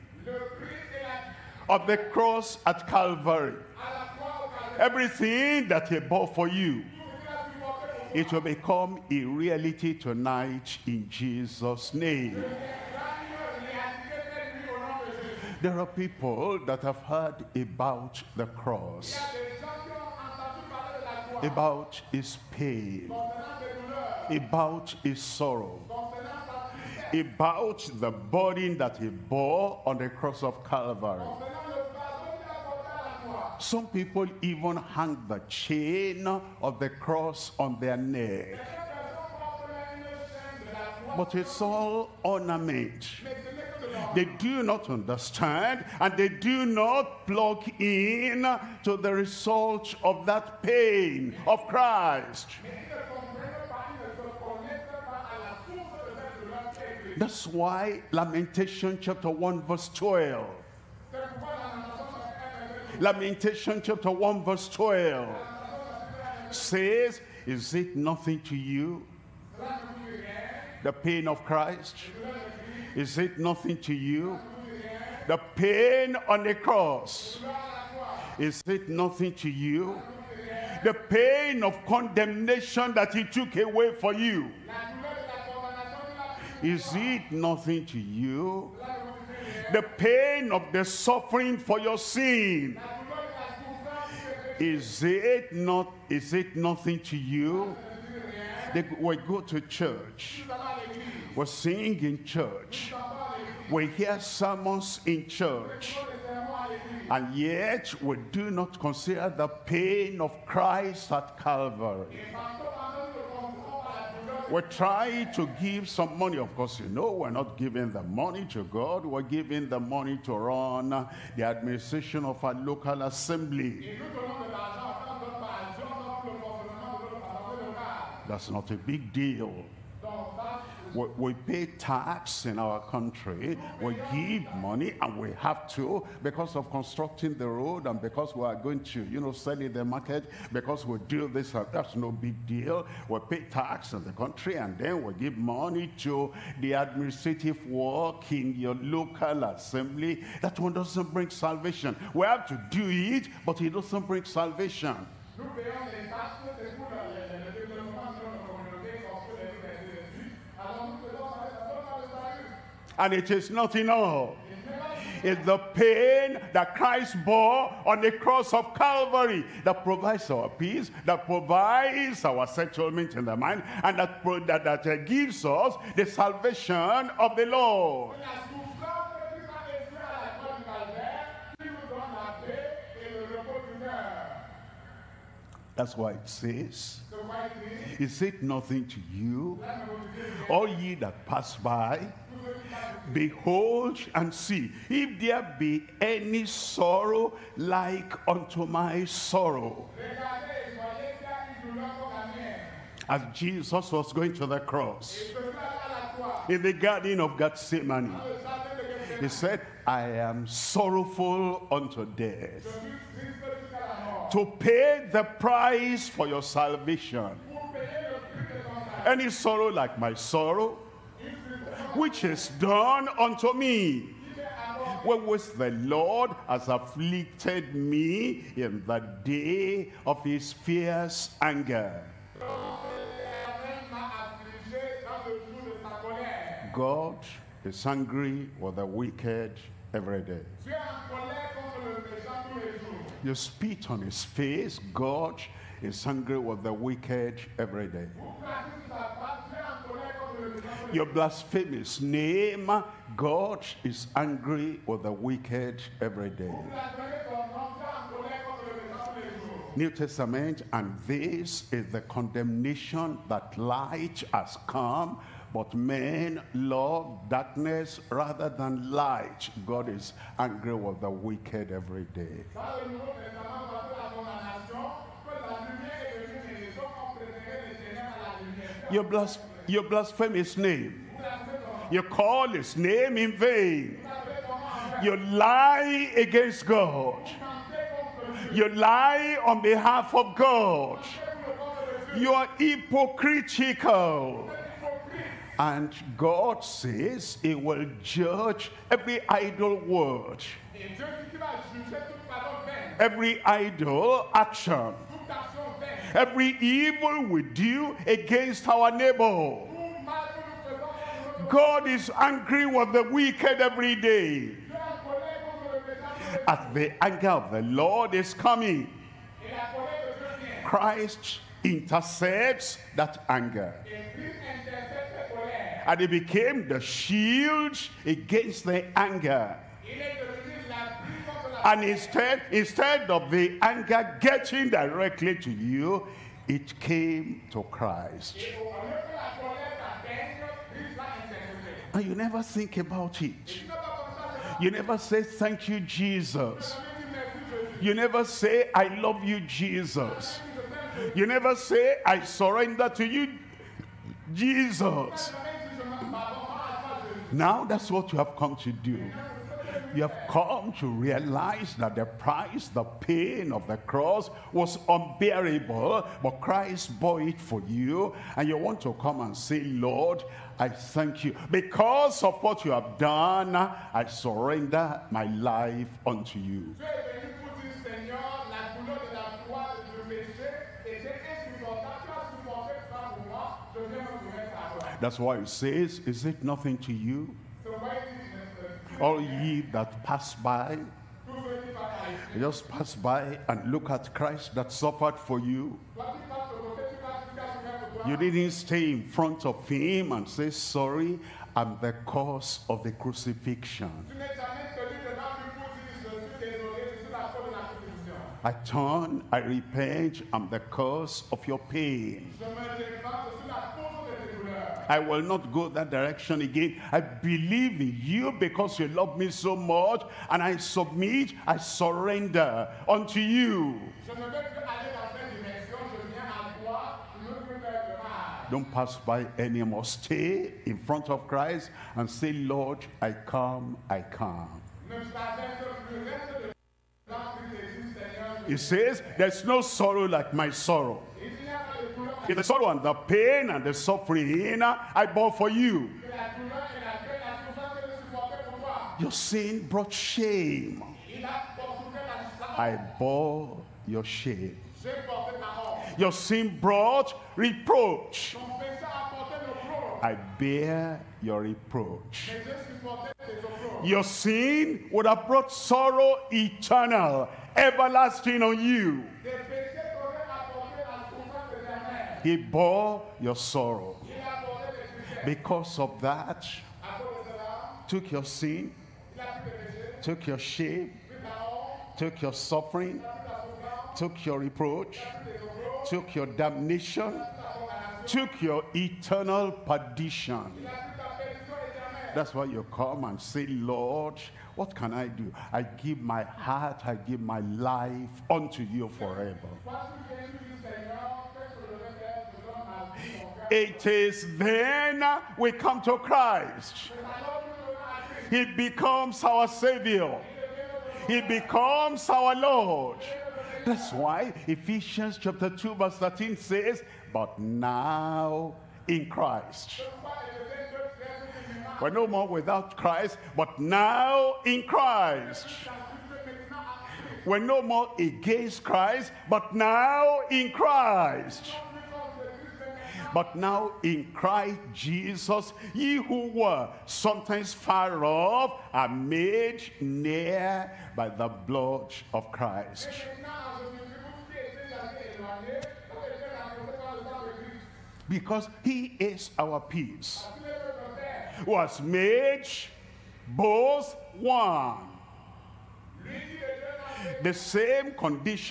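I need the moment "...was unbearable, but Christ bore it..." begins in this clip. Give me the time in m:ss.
6:04.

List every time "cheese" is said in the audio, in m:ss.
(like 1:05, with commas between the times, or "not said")
not said.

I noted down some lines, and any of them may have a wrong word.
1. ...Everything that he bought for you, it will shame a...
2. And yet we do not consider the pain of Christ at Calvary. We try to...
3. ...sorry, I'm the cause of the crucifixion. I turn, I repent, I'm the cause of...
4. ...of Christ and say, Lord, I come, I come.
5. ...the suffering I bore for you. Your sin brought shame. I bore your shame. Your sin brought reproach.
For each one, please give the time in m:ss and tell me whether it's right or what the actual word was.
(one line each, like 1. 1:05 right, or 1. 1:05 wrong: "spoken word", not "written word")
1. 0:04 wrong: "become", not "shame"
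2. 1:47 right
3. 6:40 right
4. 7:11 right
5. 7:23 right.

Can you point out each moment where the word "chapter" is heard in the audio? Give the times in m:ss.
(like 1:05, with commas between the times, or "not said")
0:58, 1:03, 8:35.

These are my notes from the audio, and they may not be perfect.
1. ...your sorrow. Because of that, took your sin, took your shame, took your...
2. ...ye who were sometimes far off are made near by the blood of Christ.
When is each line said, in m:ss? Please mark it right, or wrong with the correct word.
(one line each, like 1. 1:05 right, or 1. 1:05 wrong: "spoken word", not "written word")
1. 7:53 right
2. 8:55 right.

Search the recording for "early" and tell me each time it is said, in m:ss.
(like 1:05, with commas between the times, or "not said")
not said.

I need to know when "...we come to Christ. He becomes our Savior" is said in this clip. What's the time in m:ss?
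8:25.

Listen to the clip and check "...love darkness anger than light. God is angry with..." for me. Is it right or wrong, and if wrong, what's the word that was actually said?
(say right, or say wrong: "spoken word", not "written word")
wrong: "rather", not "anger".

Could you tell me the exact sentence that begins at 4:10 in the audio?
Your blasphemous name, God is angry with the wicked every day.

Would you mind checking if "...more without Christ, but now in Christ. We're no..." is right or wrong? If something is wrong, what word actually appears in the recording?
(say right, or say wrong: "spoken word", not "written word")
right.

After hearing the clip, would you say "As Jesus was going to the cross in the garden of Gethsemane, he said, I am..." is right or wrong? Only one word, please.
right.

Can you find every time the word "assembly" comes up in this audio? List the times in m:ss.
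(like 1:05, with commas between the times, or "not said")
2:03, 2:29.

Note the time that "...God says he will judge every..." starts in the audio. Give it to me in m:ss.
4:56.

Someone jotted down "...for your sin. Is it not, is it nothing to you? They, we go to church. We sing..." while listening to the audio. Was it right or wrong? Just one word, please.
right.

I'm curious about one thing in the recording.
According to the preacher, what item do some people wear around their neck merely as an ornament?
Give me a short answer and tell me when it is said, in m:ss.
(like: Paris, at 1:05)
chain of the cross, at 0:35.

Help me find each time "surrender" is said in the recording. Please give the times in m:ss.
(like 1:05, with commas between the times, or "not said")
5:52, 6:14, 7:01.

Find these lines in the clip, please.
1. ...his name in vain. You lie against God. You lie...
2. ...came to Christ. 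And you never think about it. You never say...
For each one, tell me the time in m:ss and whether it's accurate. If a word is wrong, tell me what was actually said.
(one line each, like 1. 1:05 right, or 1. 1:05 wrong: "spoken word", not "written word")
1. 4:42 right
2. 5:36 right.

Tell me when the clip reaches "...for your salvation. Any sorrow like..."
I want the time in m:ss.
3:36.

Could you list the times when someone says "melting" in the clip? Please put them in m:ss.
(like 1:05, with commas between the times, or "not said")
not said.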